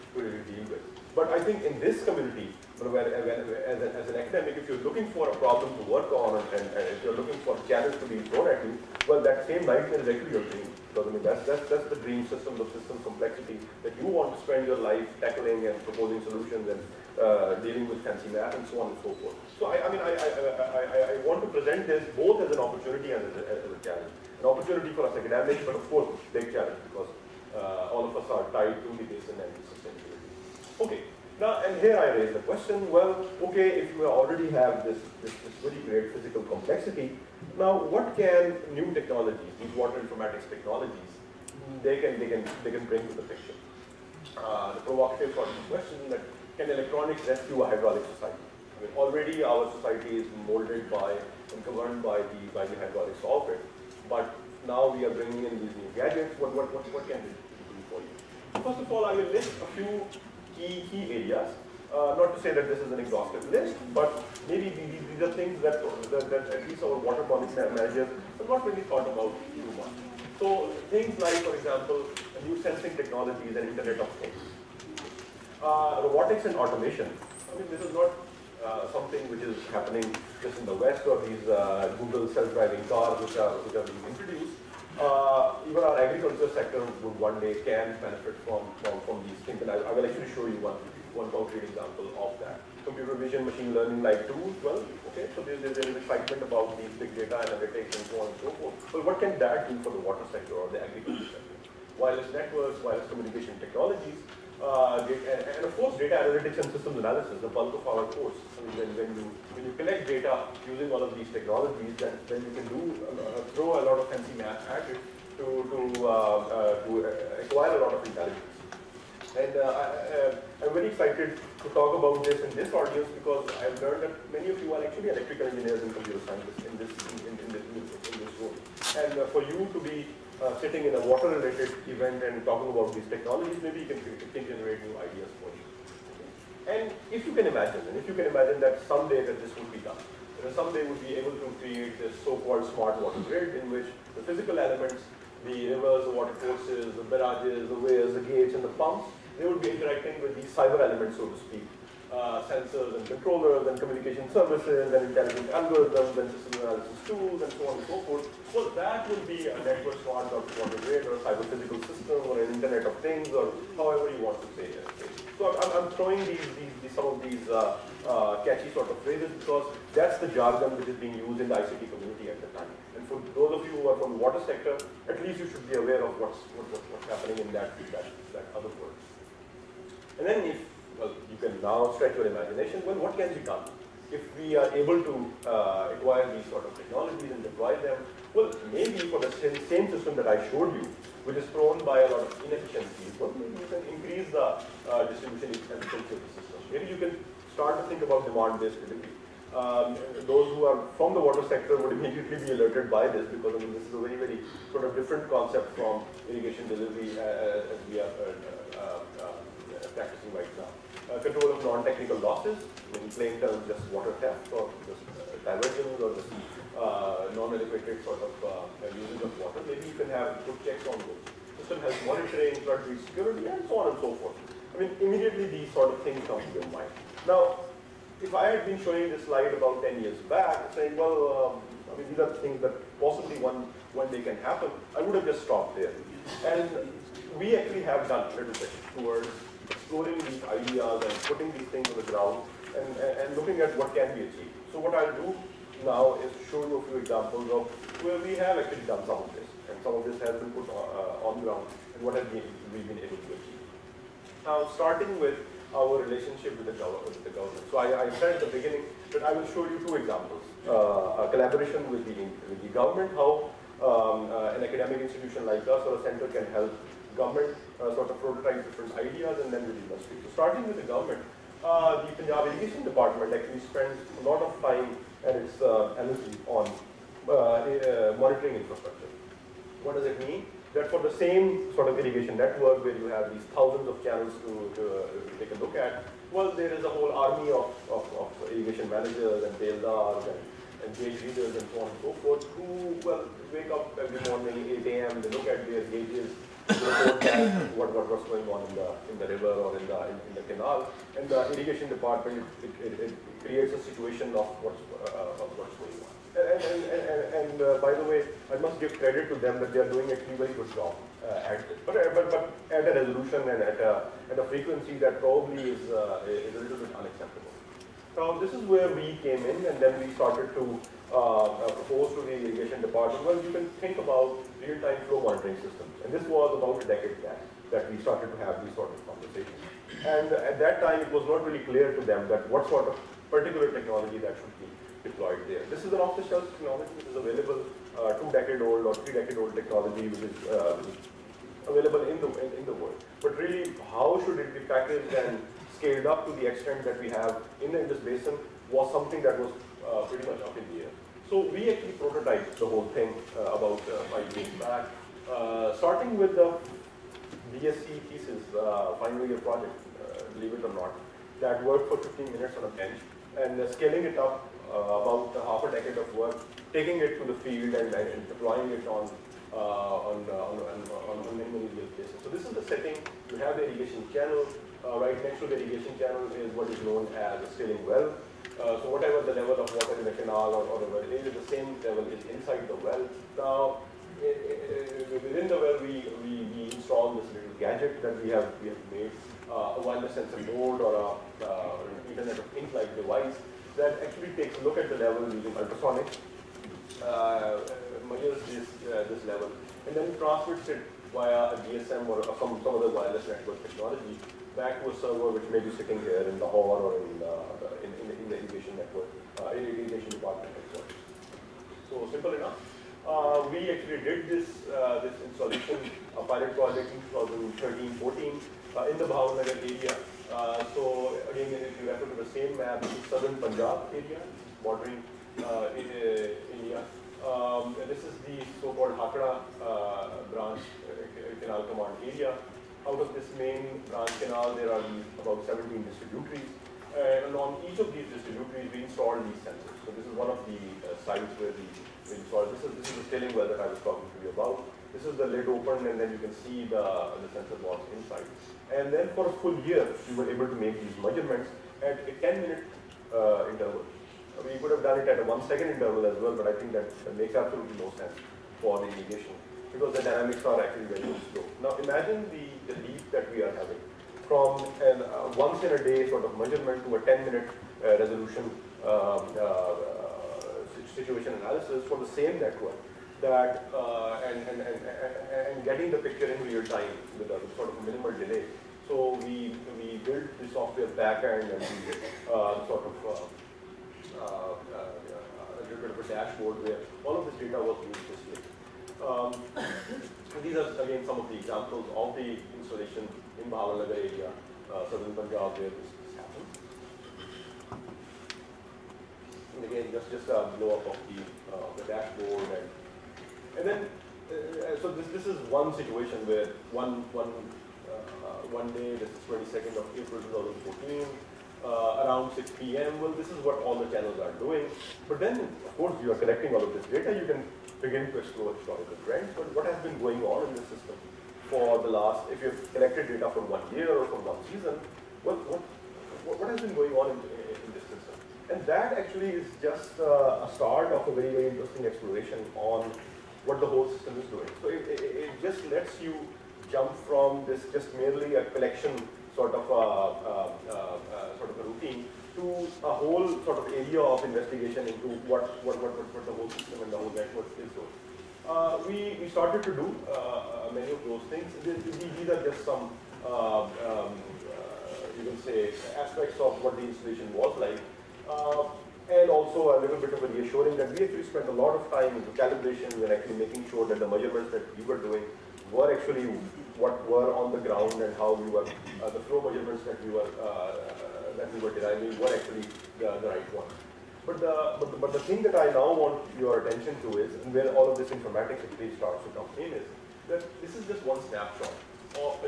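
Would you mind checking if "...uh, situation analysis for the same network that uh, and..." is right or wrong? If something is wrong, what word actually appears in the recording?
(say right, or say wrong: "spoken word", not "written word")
right.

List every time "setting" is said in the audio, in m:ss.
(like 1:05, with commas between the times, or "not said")
6:12.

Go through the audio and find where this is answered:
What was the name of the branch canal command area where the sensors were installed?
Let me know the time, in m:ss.
7:08.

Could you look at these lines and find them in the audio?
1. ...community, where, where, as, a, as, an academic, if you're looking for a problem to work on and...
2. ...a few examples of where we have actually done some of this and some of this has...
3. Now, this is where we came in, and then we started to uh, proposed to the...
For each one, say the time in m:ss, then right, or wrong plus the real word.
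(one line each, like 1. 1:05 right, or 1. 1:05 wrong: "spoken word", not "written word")
1. 0:02 right
2. 4:06 right
3. 5:18 right.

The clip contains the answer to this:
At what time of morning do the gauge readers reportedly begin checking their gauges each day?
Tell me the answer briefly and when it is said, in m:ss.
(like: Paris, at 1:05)
8 a.m., at 4:54.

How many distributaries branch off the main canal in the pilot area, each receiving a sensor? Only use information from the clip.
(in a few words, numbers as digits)
17.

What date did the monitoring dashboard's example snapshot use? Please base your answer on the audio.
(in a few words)
22 April 2014.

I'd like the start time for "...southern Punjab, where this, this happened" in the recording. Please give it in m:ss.
8:14.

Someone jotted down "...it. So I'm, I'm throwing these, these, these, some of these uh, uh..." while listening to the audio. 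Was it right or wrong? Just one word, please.
right.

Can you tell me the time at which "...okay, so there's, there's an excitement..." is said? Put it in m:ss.
1:35.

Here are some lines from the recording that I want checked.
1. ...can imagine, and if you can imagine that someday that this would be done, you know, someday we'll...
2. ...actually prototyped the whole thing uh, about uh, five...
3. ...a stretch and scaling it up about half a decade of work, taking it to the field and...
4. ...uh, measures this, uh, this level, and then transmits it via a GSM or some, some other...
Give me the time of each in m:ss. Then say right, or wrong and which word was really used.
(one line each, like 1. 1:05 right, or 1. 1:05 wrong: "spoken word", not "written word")
1. 2:17 right
2. 5:51 right
3. 6:02 wrong: "bench", not "stretch"
4. 6:37 right.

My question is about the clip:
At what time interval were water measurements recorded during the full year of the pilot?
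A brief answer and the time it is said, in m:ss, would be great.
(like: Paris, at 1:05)
10 minutes, at 7:32.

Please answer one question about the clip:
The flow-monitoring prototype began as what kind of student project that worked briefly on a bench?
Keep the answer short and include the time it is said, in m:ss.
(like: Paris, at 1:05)
BSc thesis, at 5:57.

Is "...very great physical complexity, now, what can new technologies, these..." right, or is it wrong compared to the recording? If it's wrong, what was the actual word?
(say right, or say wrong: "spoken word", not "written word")
right.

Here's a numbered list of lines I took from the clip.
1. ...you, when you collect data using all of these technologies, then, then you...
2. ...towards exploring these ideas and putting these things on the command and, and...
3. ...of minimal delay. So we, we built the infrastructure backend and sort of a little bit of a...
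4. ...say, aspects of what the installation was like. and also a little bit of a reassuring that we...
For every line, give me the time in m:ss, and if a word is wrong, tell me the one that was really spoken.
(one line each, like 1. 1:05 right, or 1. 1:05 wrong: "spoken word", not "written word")
1. 1:49 right
2. 3:58 wrong: "ground", not "command"
3. 7:57 wrong: "software", not "infrastructure"
4. 9:15 right.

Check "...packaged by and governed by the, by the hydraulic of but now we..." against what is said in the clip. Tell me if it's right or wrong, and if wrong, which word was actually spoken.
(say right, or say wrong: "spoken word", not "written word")
wrong: "molded", not "packaged".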